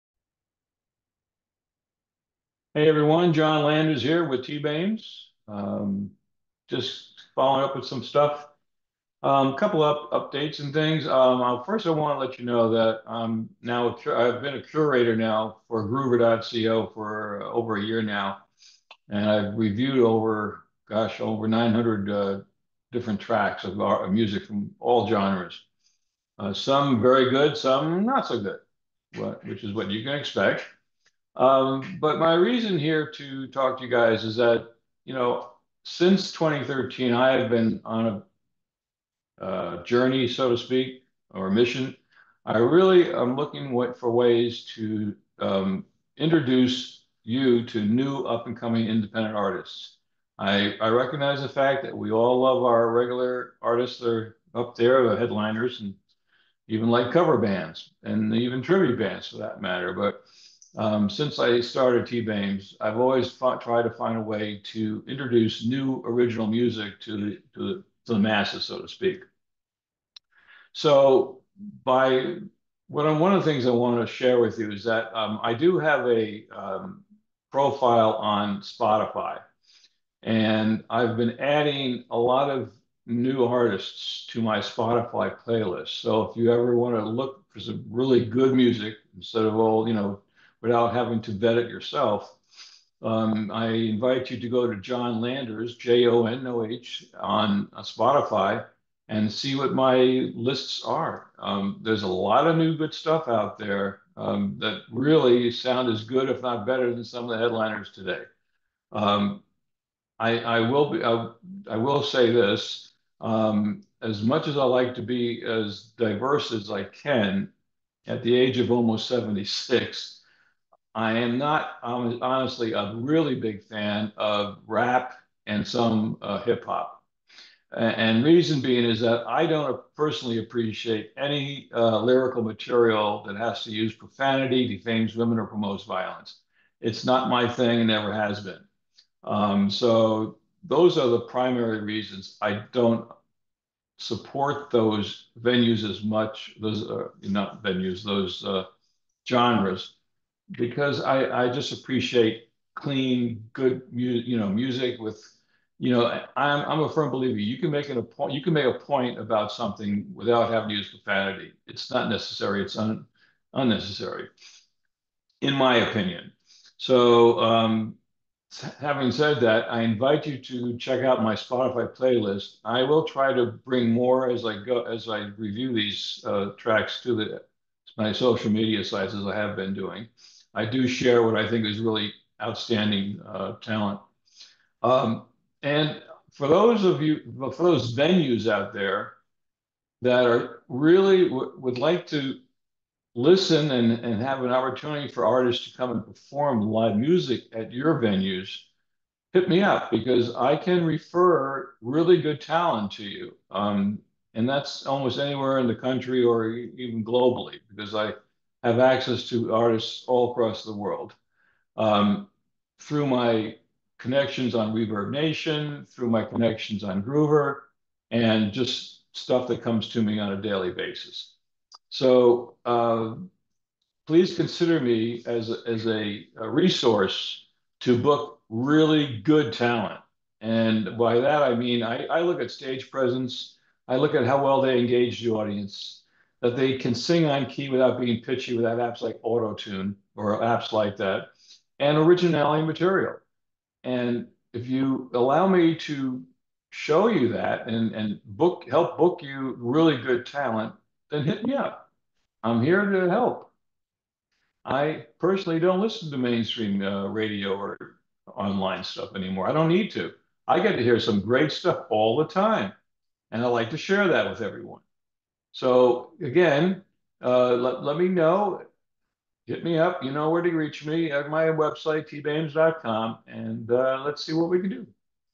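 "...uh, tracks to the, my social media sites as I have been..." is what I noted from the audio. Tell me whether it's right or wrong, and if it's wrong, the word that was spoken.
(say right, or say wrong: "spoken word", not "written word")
right.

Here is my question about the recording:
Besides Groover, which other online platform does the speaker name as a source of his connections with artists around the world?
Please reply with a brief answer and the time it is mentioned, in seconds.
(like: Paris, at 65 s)
ReverbNation, at 214 s.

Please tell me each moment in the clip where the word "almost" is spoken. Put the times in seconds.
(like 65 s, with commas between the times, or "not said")
118 s, 204 s.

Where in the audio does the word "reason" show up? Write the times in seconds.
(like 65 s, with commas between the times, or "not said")
32 s, 128 s, 141 s.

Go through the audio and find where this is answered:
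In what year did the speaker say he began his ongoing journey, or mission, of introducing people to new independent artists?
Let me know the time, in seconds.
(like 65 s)
36 s.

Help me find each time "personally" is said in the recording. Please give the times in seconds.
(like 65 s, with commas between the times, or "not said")
129 s, 255 s.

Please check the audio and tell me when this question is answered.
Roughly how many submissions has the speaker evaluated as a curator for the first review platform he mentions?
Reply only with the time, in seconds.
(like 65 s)
21 s.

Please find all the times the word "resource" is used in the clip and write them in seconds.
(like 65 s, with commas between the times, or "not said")
226 s.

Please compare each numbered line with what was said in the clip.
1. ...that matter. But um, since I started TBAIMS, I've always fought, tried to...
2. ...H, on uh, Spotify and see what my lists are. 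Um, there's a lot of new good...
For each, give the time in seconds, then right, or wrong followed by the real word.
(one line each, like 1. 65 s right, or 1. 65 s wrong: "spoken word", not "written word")
1. 59 s right
2. 96 s right.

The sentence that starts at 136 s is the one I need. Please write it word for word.
It's not my thing and never has been.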